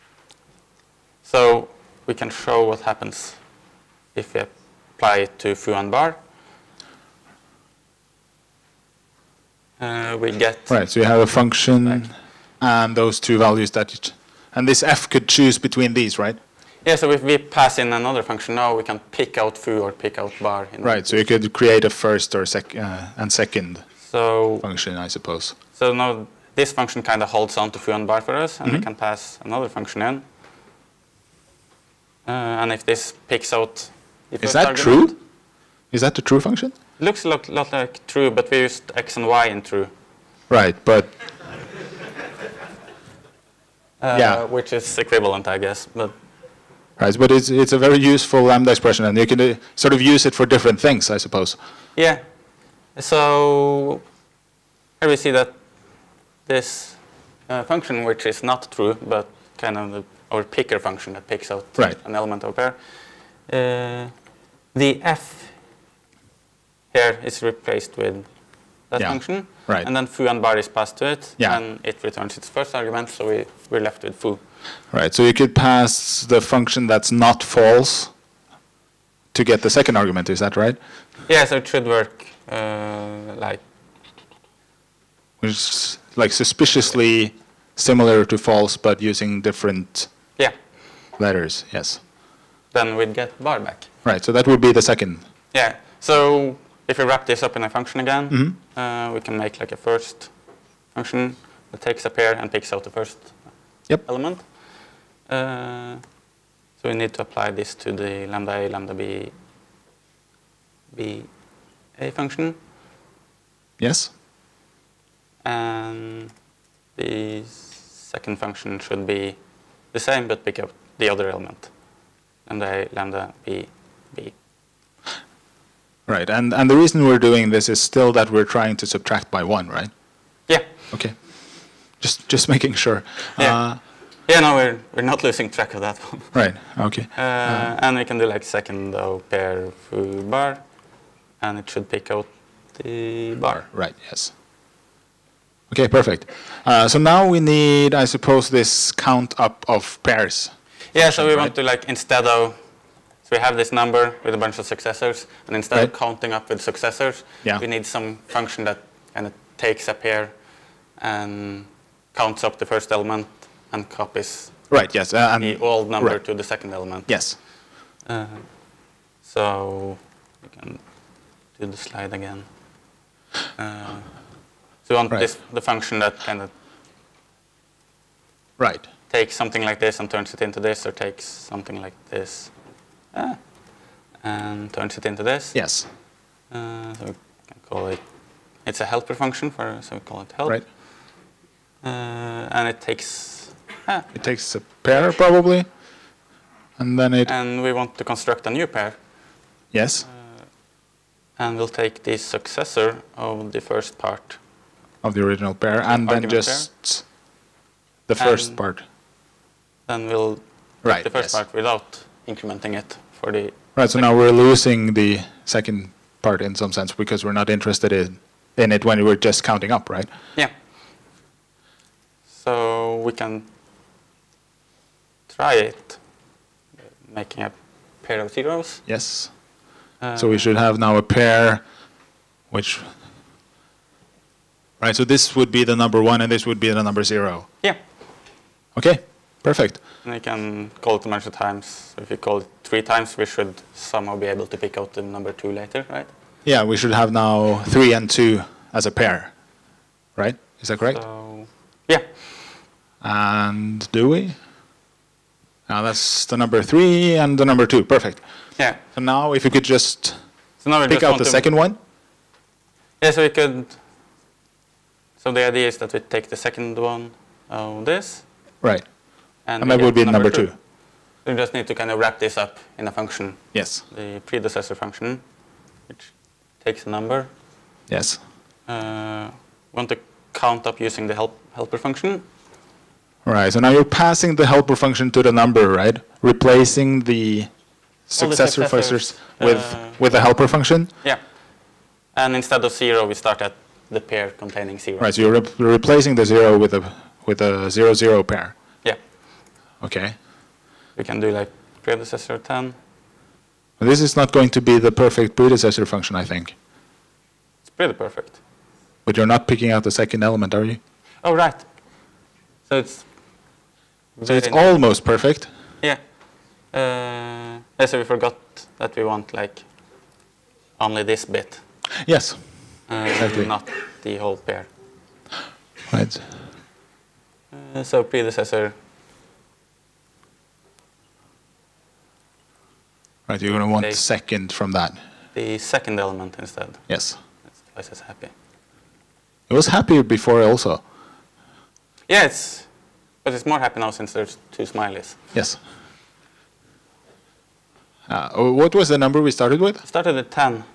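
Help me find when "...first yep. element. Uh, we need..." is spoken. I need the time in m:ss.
1:42.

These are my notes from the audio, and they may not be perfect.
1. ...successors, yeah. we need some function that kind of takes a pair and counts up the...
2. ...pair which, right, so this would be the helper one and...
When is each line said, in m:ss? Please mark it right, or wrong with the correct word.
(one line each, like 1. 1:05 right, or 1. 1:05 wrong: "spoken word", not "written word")
1. 2:36 right
2. 3:51 wrong: "number", not "helper".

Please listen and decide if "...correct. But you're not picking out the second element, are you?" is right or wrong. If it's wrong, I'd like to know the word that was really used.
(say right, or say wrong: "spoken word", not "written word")
wrong: "perfect", not "correct".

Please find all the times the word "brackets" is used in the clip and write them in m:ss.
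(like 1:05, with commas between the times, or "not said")
not said.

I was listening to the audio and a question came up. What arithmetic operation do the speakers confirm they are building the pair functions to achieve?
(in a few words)
subtract by one.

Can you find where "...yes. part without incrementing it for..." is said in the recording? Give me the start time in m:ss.
3:31.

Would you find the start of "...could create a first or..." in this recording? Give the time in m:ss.
0:21.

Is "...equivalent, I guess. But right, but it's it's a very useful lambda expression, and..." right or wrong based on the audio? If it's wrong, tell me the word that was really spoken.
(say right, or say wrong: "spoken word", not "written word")
right.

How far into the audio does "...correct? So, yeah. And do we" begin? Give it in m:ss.
4:10.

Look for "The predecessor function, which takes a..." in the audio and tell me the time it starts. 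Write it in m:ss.
4:33.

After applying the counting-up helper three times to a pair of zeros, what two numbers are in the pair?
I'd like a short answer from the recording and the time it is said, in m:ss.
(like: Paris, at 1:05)
3 and 2, at 4:07.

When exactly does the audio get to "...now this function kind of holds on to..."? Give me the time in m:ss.
0:25.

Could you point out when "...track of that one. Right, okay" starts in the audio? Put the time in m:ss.
2:15.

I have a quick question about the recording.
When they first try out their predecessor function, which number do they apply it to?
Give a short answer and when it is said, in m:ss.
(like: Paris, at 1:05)
10, at 5:01.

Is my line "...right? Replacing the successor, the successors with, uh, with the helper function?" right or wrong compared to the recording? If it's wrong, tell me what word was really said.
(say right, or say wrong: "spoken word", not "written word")
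right.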